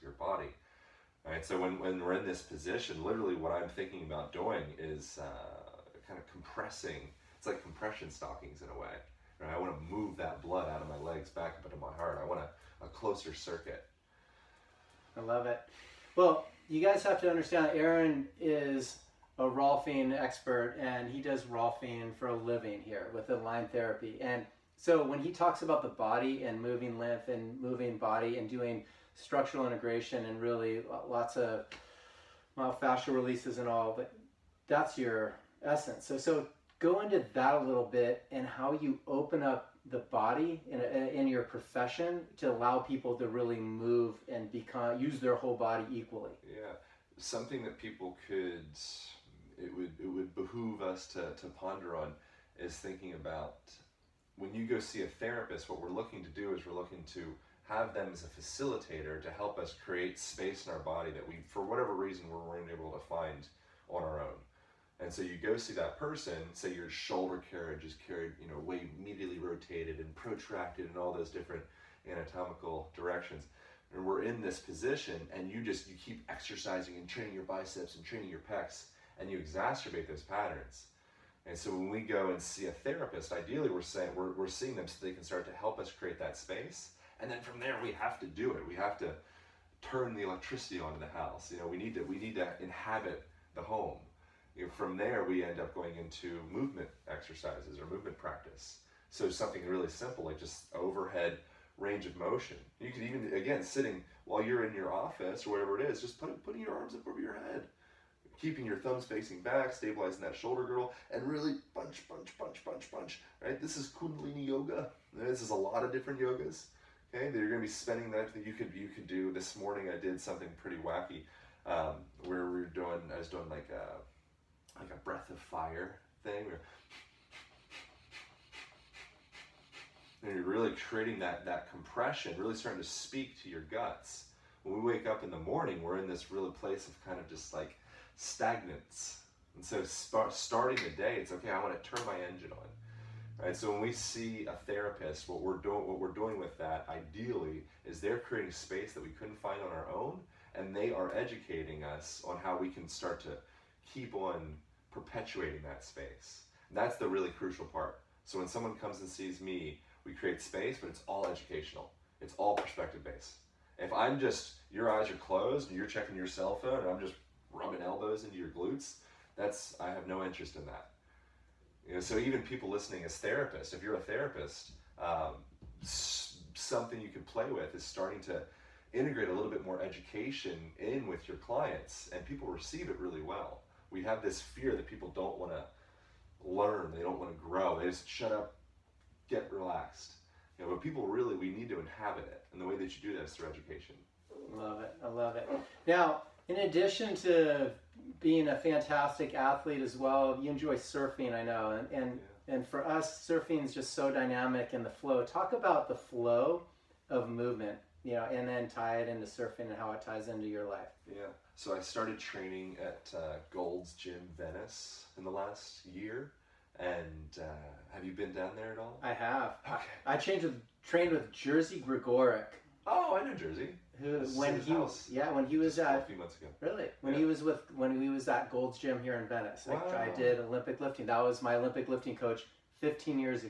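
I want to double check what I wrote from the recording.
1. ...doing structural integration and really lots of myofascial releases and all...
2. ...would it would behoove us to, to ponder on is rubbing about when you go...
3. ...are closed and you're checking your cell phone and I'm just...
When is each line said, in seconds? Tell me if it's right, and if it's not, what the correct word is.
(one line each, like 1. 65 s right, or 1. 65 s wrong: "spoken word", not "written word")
1. 28 s right
2. 49 s wrong: "thinking", not "rubbing"
3. 165 s right.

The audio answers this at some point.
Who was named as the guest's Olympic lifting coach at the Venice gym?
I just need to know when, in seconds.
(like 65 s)
221 s.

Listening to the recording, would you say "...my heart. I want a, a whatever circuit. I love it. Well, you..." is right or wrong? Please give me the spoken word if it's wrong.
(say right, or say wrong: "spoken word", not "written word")
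wrong: "closer", not "whatever".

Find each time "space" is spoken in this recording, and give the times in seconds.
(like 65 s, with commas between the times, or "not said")
60 s, 86 s, 148 s, 155 s, 160 s.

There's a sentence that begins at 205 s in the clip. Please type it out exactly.
Talk about the flow of movement, you know, and then tie it into surfing and how it ties into your life.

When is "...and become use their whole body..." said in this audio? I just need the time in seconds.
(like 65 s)
44 s.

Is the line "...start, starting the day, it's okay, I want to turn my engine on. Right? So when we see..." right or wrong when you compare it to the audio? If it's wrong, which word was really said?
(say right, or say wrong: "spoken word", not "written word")
right.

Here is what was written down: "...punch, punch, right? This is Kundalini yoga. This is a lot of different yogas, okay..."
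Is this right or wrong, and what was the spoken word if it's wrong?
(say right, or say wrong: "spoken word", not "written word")
right.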